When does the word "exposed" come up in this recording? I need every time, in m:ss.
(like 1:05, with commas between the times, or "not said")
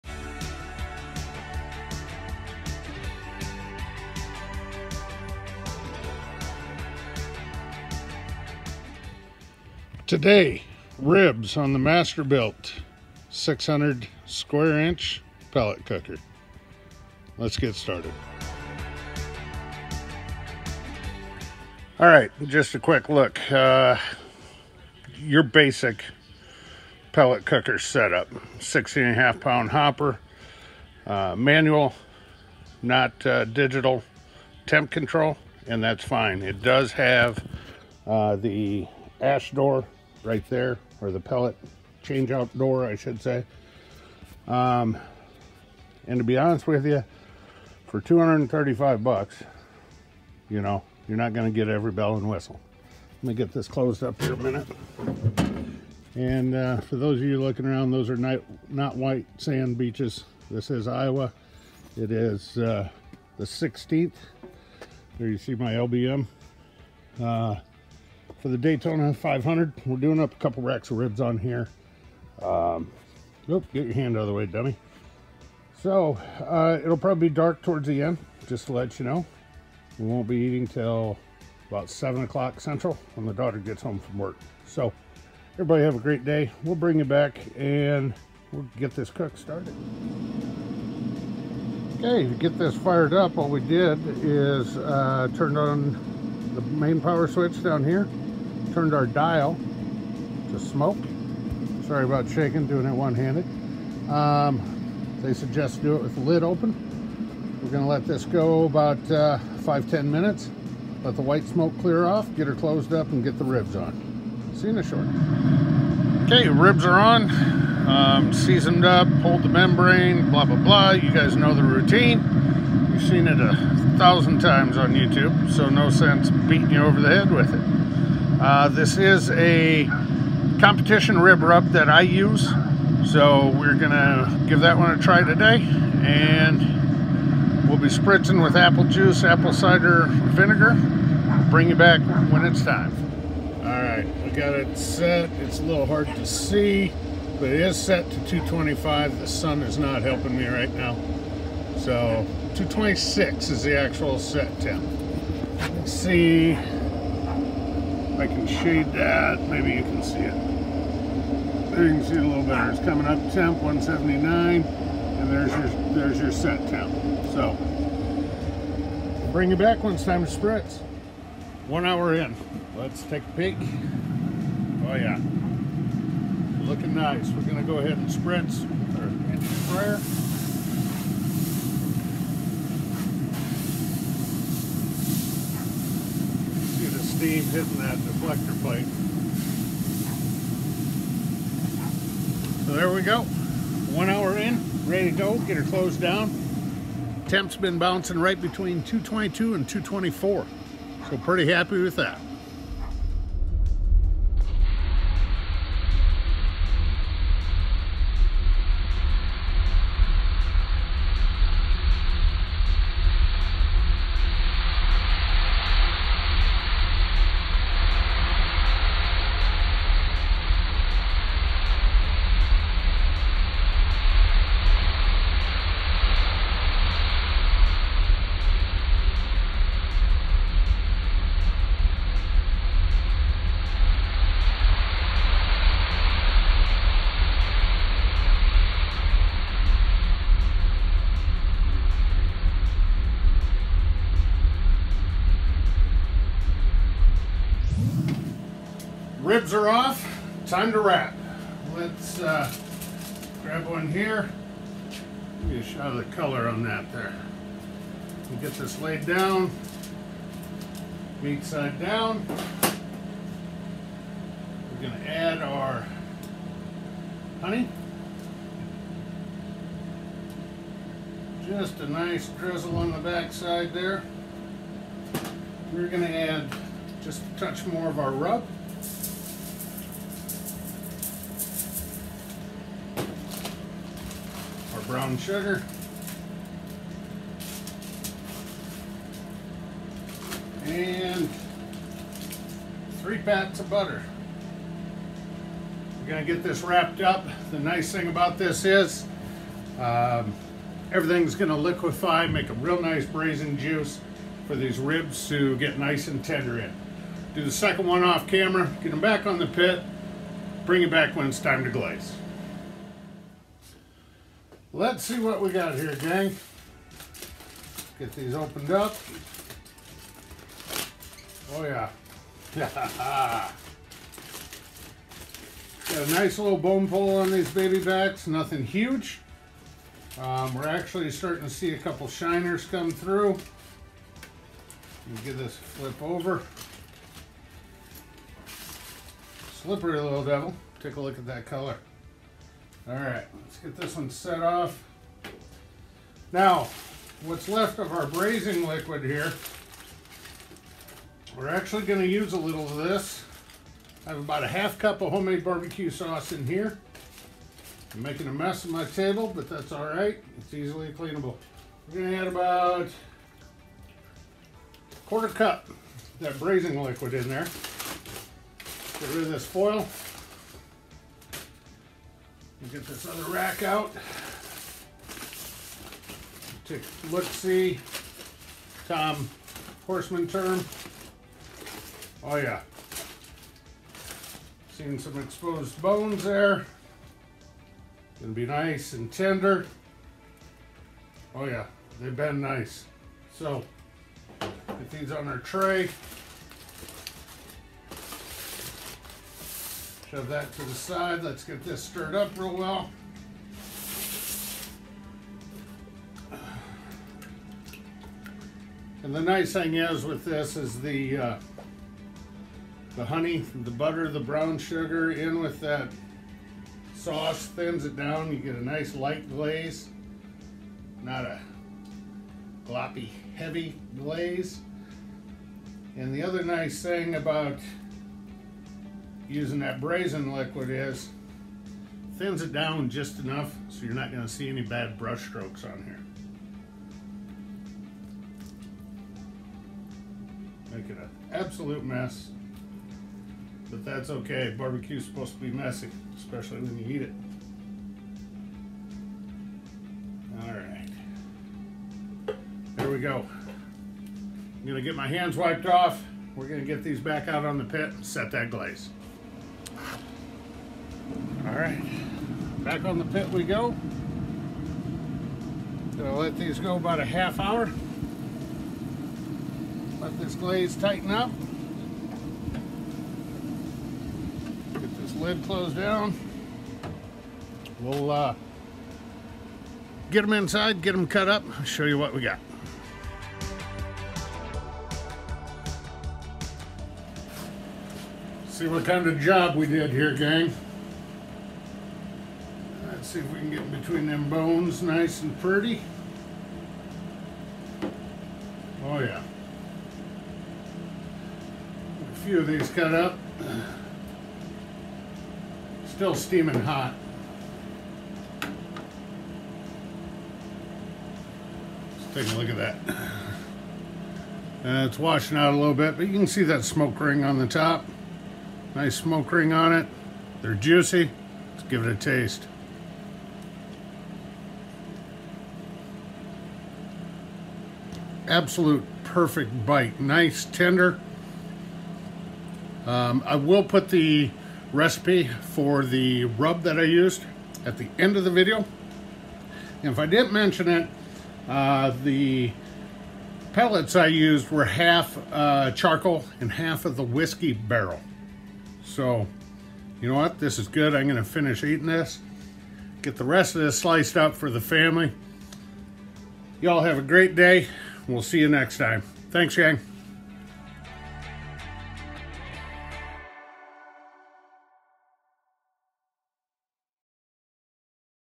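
6:25.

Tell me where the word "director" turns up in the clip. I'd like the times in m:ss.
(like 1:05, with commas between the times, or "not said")
not said.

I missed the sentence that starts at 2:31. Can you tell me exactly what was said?
So 226 is the actual set temp.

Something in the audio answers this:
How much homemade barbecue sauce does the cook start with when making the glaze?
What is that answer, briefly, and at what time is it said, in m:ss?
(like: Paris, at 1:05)
half cup, at 5:54.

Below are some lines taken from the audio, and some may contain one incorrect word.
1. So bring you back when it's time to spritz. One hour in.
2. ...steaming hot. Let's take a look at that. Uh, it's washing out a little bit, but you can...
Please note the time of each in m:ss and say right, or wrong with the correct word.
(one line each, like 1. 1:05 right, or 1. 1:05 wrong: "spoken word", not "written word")
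1. 2:47 right
2. 8:26 right.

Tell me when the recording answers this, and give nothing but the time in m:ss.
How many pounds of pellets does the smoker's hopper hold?
0:28.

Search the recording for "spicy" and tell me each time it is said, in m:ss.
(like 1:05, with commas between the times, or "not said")
not said.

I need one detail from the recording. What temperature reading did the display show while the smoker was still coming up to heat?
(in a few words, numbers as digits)
179.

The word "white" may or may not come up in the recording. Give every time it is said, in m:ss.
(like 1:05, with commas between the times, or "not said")
0:58, 1:51.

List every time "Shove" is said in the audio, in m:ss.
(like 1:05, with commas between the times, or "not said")
6:40.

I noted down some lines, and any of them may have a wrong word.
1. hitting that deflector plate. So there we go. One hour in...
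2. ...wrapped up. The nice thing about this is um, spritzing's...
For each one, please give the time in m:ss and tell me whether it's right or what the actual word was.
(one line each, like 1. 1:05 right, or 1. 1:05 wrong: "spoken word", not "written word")
1. 3:07 right
2. 4:56 wrong: "everything", not "spritzing".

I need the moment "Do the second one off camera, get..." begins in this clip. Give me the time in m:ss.
5:07.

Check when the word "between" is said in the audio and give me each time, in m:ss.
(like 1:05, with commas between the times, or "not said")
3:18, 8:13.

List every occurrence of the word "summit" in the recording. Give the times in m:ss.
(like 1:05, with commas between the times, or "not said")
not said.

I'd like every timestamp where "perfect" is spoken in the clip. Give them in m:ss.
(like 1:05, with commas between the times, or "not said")
8:49.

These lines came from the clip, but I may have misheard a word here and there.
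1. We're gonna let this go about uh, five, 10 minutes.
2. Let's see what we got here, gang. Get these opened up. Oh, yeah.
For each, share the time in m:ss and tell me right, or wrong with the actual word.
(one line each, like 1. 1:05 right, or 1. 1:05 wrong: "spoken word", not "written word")
1. 1:47 right
2. 5:14 right.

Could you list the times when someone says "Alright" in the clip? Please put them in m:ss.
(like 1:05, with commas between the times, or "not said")
7:41.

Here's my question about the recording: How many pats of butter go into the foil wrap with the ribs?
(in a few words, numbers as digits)
3.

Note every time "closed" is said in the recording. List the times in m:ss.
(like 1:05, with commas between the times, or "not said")
0:53, 1:52, 3:15, 7:55.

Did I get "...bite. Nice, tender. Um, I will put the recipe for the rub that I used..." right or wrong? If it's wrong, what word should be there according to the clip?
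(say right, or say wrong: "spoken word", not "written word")
right.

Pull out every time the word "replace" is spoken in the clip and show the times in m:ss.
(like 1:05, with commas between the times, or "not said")
not said.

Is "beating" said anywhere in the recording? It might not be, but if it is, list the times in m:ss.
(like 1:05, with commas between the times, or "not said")
2:06.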